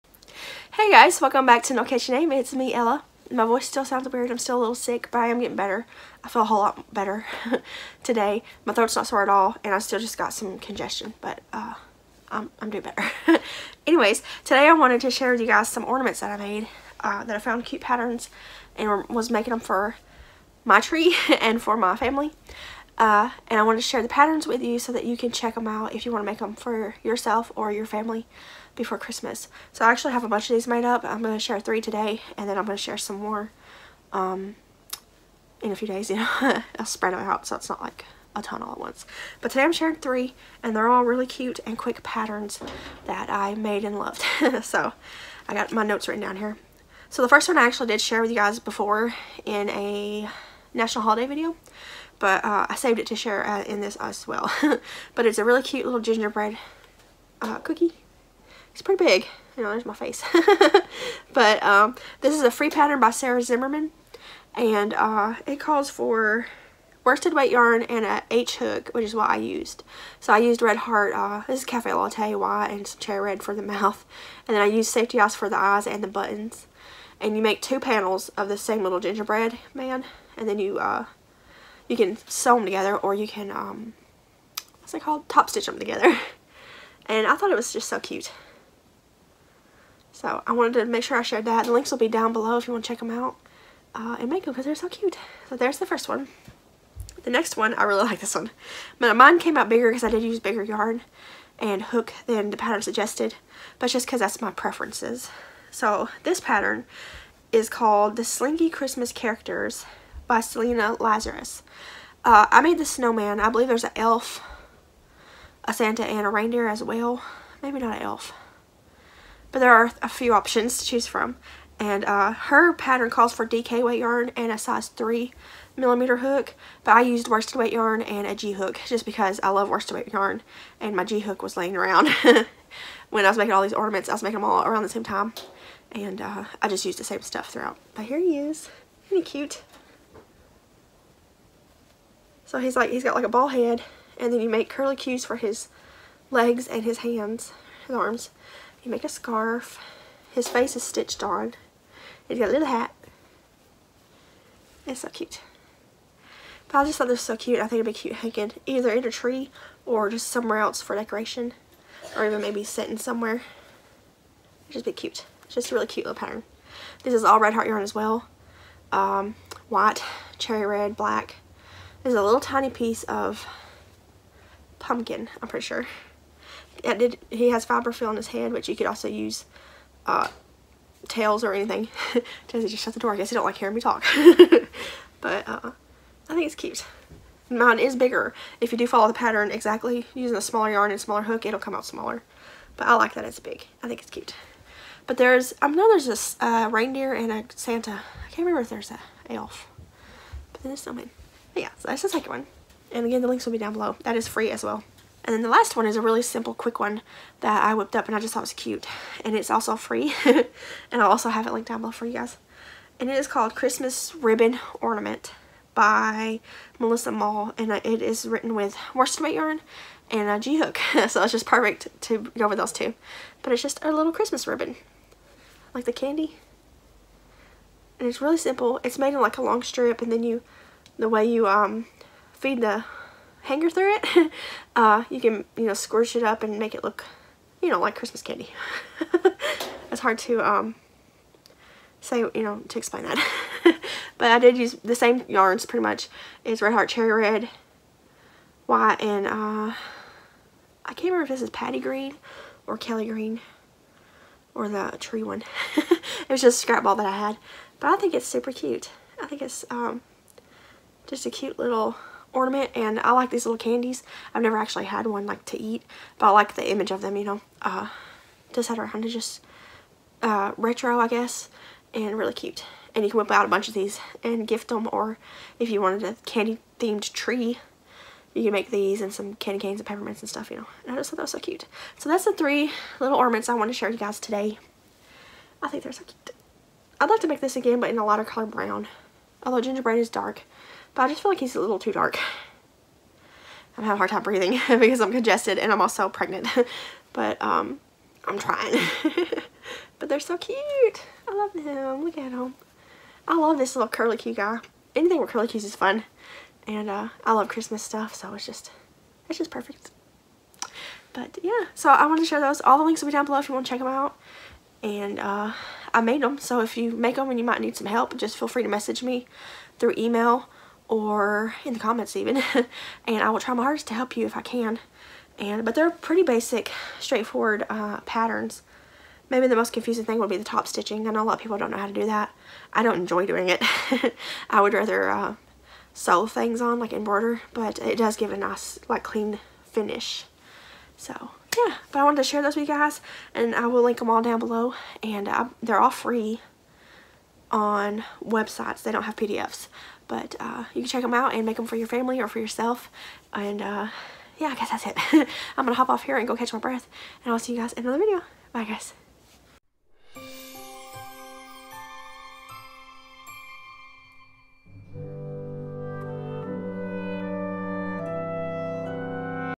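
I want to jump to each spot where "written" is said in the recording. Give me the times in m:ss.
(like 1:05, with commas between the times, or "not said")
0:46, 3:38.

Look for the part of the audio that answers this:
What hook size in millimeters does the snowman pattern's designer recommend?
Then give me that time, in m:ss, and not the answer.
2:04.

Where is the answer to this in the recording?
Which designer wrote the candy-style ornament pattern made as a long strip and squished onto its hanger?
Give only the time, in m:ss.
3:36.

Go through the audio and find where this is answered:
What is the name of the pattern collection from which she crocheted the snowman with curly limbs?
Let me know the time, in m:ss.
1:48.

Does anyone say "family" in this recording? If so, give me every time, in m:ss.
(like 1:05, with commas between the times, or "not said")
0:21, 0:27, 5:51.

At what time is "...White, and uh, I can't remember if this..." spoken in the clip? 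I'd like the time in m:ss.
4:08.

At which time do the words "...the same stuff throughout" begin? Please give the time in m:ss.
2:16.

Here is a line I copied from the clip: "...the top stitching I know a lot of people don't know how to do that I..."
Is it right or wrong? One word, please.
right.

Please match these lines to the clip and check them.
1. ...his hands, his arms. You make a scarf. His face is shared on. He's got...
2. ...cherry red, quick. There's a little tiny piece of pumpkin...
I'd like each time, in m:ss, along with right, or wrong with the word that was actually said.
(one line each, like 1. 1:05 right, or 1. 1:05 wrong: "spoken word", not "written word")
1. 2:26 wrong: "stitched", not "shared"
2. 2:50 wrong: "black", not "quick".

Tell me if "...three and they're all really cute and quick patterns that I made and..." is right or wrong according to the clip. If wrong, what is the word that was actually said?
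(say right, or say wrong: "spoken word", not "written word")
right.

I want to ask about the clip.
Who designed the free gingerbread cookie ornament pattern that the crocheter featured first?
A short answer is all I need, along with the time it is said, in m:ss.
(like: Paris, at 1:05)
Sarah Zimmerman, at 1:03.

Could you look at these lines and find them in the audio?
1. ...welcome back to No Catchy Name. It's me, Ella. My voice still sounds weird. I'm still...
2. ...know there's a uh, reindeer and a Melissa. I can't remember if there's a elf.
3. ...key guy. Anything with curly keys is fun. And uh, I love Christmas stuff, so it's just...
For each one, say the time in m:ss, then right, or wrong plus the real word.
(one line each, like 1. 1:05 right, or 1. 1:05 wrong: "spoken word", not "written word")
1. 0:01 right
2. 3:15 wrong: "Santa", not "Melissa"
3. 5:04 right.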